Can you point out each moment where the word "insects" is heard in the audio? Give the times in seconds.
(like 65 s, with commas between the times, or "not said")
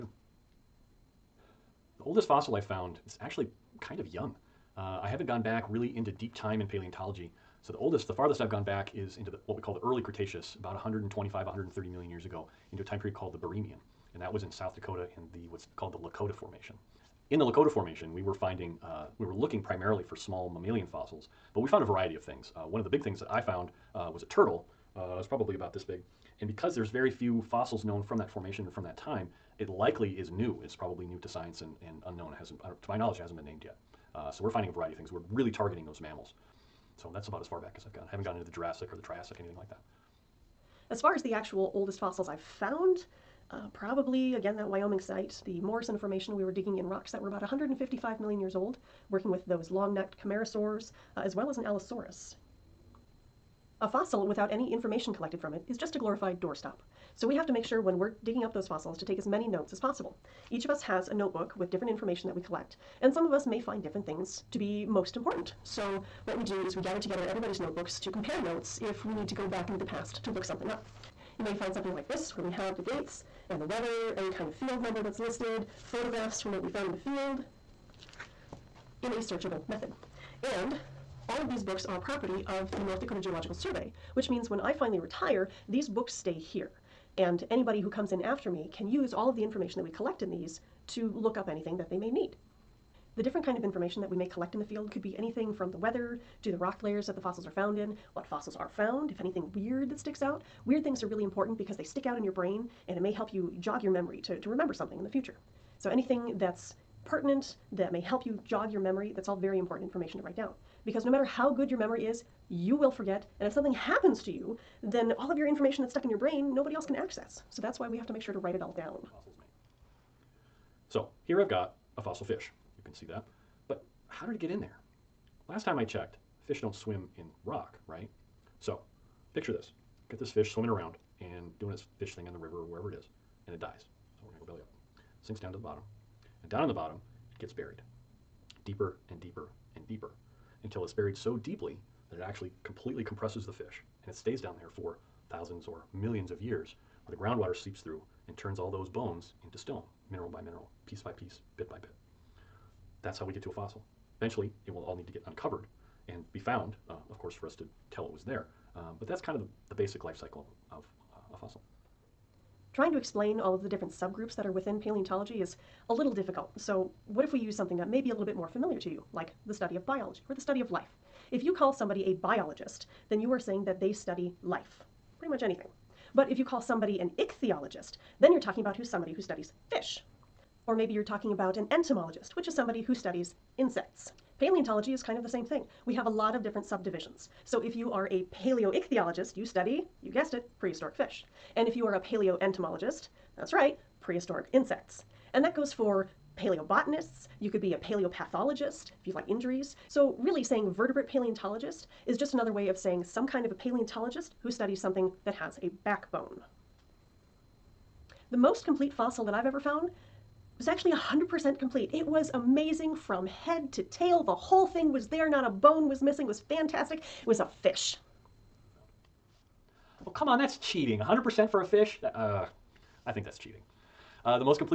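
183 s, 194 s.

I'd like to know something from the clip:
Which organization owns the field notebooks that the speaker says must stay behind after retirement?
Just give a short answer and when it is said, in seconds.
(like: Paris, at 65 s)
North Dakota Geological Survey, at 82 s.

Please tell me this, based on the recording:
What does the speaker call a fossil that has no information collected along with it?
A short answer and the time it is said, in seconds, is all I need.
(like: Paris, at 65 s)
a glorified doorstop, at 55 s.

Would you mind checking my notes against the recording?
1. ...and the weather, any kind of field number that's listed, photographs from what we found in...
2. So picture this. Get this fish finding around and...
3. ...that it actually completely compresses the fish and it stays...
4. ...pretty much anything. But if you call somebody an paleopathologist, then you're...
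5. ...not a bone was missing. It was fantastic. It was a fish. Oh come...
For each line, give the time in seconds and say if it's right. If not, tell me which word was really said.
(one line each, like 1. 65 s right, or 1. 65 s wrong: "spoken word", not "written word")
1. 73 s right
2. 128 s wrong: "swimming", not "finding"
3. 142 s right
4. 175 s wrong: "ichthyologist", not "paleopathologist"
5. 215 s right.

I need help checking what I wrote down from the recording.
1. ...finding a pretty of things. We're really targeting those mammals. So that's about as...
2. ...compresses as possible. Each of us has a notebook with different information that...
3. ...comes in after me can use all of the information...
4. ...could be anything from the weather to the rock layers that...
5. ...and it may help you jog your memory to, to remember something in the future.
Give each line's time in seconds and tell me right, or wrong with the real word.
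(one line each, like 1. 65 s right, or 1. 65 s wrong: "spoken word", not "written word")
1. 34 s wrong: "variety", not "pretty"
2. 59 s wrong: "notes", not "compresses"
3. 87 s right
4. 94 s right
5. 102 s right.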